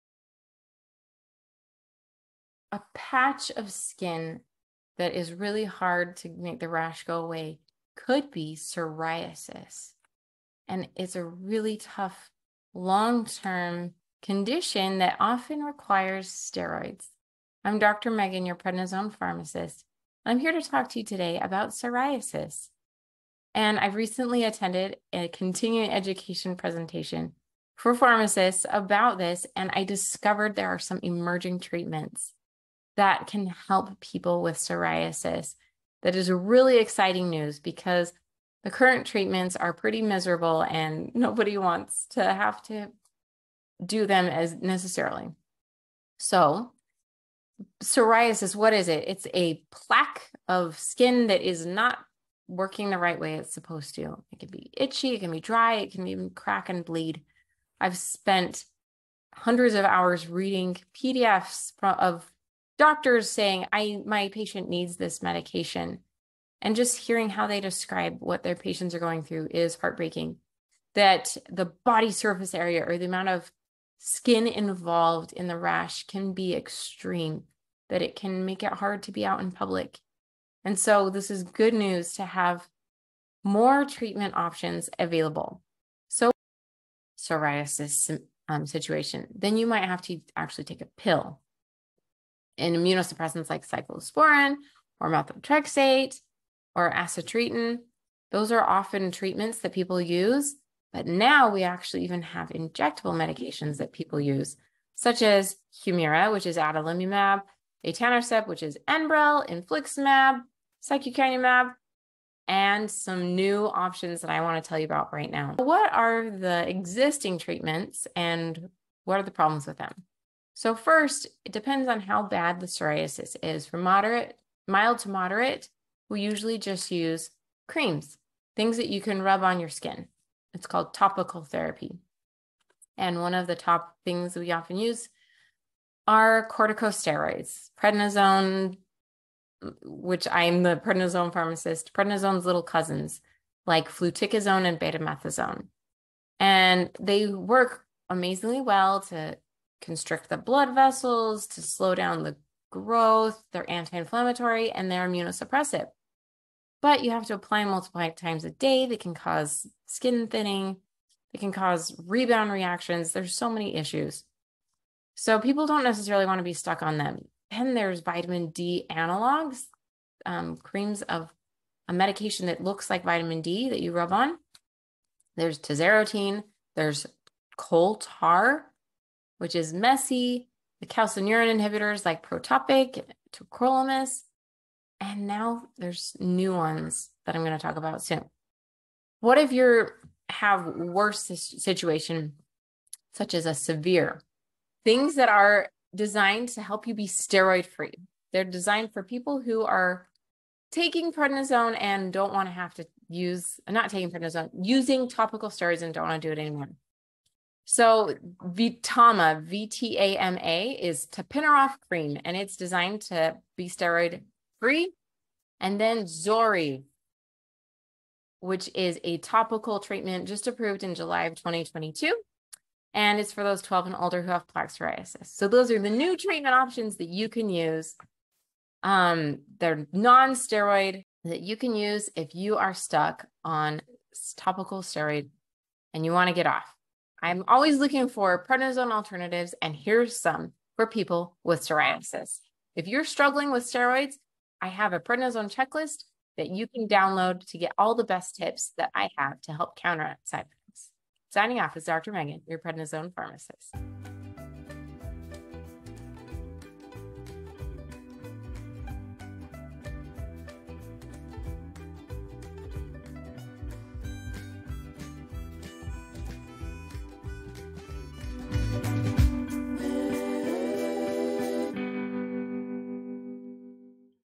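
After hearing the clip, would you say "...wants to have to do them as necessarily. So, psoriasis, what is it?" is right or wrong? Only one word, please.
right.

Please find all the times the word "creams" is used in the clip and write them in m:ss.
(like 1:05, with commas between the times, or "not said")
2:07, 2:50, 3:31.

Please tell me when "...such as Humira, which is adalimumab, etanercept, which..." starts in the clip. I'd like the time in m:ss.
1:44.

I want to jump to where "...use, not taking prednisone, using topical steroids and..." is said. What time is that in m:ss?
3:23.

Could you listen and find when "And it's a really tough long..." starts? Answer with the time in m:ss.
0:10.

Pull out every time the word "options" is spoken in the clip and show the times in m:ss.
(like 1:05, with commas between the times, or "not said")
1:24, 1:53, 3:46.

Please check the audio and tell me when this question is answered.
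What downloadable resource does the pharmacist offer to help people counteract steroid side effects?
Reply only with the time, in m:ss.
4:04.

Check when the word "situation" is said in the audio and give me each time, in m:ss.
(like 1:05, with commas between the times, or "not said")
1:28, 3:11.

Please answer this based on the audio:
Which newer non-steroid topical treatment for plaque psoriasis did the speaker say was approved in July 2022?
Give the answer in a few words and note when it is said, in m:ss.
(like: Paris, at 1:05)
Zori, at 3:36.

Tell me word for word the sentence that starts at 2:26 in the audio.
And they work amazingly well to constrict the blood vessels, to slow down the growth.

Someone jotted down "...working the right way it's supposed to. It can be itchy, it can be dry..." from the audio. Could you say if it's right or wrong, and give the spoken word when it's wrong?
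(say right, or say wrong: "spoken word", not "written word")
right.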